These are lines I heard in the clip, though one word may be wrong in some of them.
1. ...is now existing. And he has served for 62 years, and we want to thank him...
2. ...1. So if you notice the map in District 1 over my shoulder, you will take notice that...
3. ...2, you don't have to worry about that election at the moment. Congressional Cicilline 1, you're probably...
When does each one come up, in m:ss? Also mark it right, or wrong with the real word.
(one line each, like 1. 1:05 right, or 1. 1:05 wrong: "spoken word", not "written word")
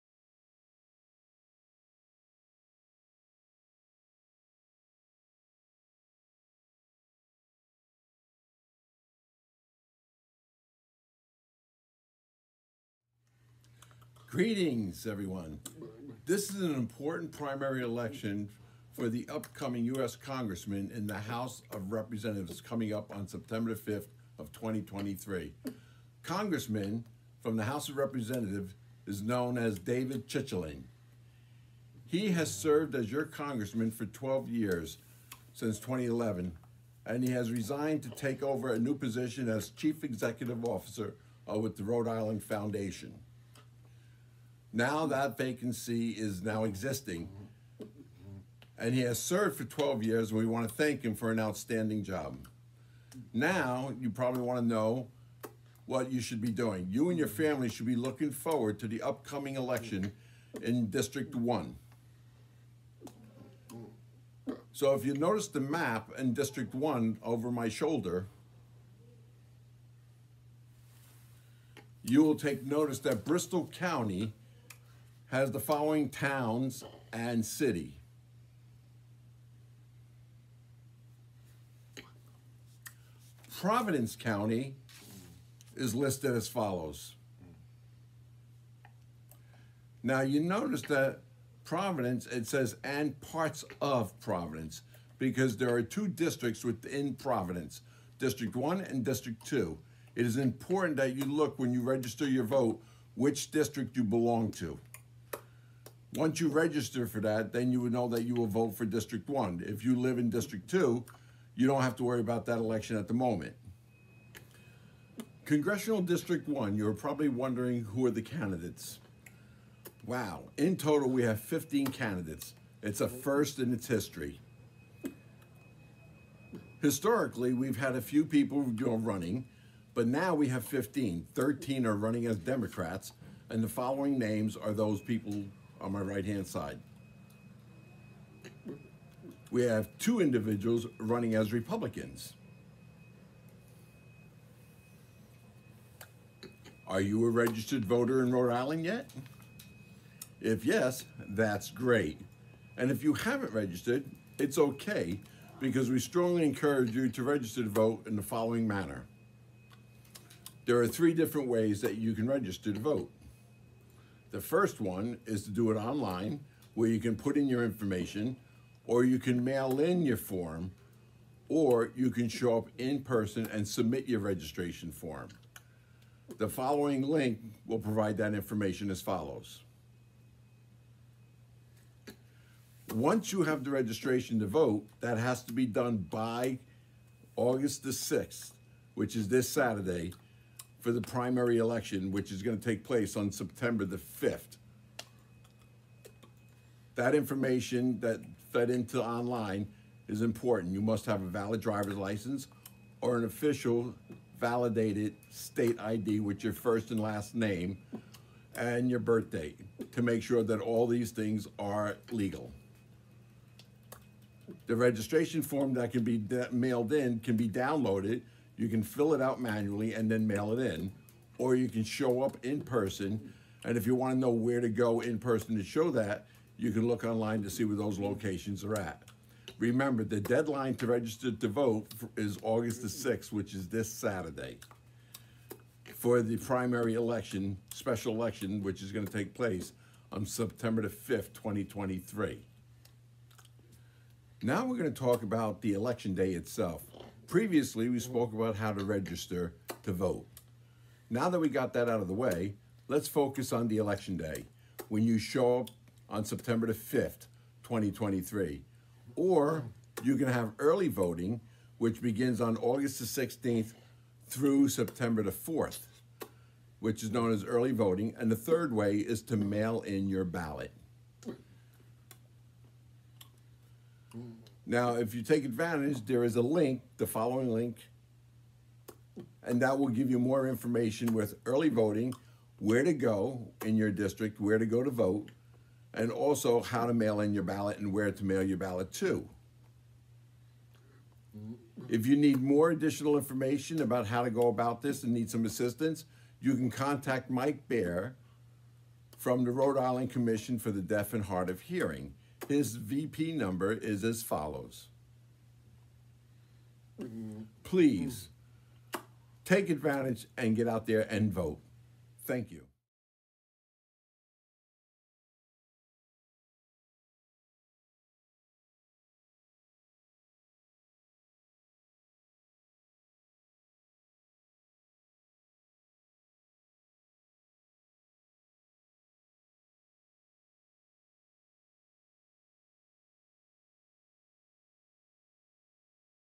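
1. 0:46 wrong: "12", not "62"
2. 1:01 right
3. 1:50 wrong: "District", not "Cicilline".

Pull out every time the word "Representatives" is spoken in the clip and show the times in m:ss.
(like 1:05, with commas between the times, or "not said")
0:21, 0:27.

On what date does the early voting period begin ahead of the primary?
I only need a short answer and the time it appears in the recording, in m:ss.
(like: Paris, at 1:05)
August 16, at 4:22.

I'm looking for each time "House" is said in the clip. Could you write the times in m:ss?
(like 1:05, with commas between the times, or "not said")
0:21, 0:27.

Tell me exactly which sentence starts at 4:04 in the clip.
Now we're going to talk about the election day itself.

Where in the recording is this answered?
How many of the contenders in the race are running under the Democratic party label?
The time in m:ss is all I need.
2:11.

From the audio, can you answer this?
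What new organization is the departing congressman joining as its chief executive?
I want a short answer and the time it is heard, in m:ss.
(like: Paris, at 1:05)
Rhode Island Foundation, at 0:41.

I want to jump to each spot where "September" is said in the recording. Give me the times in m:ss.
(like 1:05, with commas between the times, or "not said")
0:23, 3:13, 4:00, 4:16, 4:24.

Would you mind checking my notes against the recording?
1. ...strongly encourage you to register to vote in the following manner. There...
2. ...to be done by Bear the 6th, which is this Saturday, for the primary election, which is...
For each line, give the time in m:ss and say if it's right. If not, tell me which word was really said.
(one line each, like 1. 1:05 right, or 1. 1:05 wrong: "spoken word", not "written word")
1. 2:35 right
2. 3:05 wrong: "August", not "Bear".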